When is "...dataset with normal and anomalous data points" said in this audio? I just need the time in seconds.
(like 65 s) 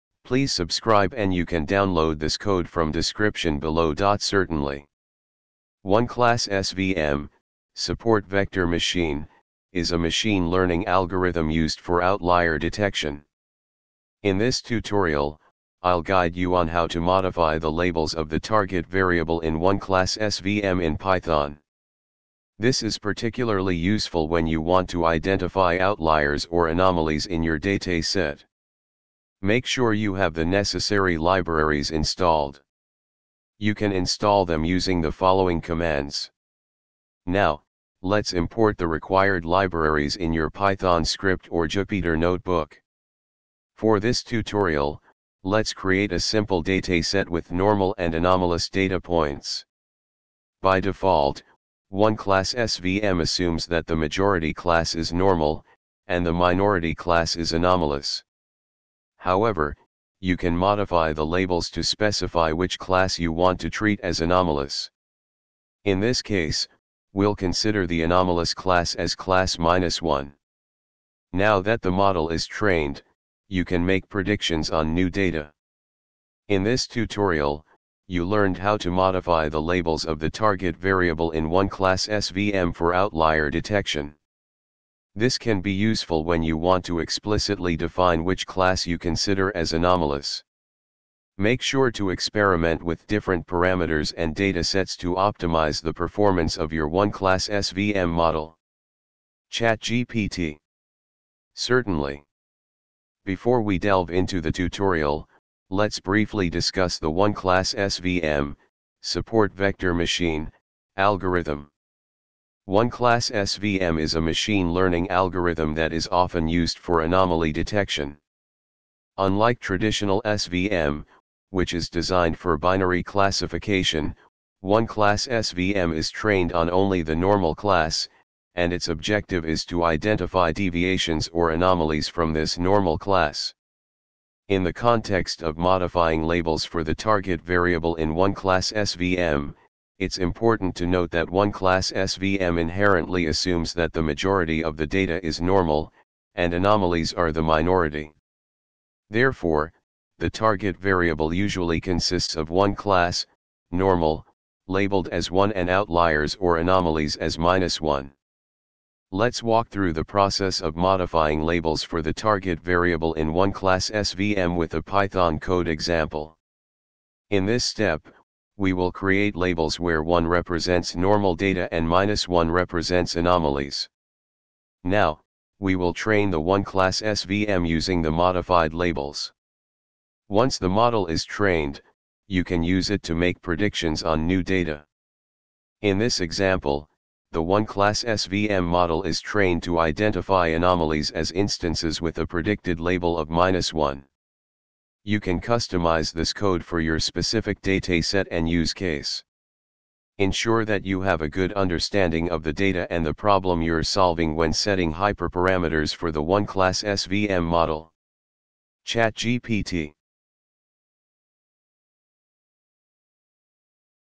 46 s.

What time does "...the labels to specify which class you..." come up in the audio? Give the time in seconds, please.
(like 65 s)
61 s.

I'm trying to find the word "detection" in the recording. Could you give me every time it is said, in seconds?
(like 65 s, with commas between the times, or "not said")
12 s, 83 s, 117 s.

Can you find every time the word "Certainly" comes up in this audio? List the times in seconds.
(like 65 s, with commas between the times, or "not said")
4 s, 101 s.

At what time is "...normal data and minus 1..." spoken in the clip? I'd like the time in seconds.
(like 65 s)
170 s.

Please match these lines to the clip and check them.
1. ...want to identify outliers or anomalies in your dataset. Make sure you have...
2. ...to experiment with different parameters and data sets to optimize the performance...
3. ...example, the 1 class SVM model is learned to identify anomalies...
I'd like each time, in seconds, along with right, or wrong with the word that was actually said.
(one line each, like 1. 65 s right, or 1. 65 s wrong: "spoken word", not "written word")
1. 24 s right
2. 91 s right
3. 186 s wrong: "trained", not "learned".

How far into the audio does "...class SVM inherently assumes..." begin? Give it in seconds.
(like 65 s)
141 s.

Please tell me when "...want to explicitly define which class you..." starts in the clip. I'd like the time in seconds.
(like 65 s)
86 s.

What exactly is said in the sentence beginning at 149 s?
Therefore, the target variable usually consists of one class, normal, labeled as 1 and outliers or anomalies as minus 1.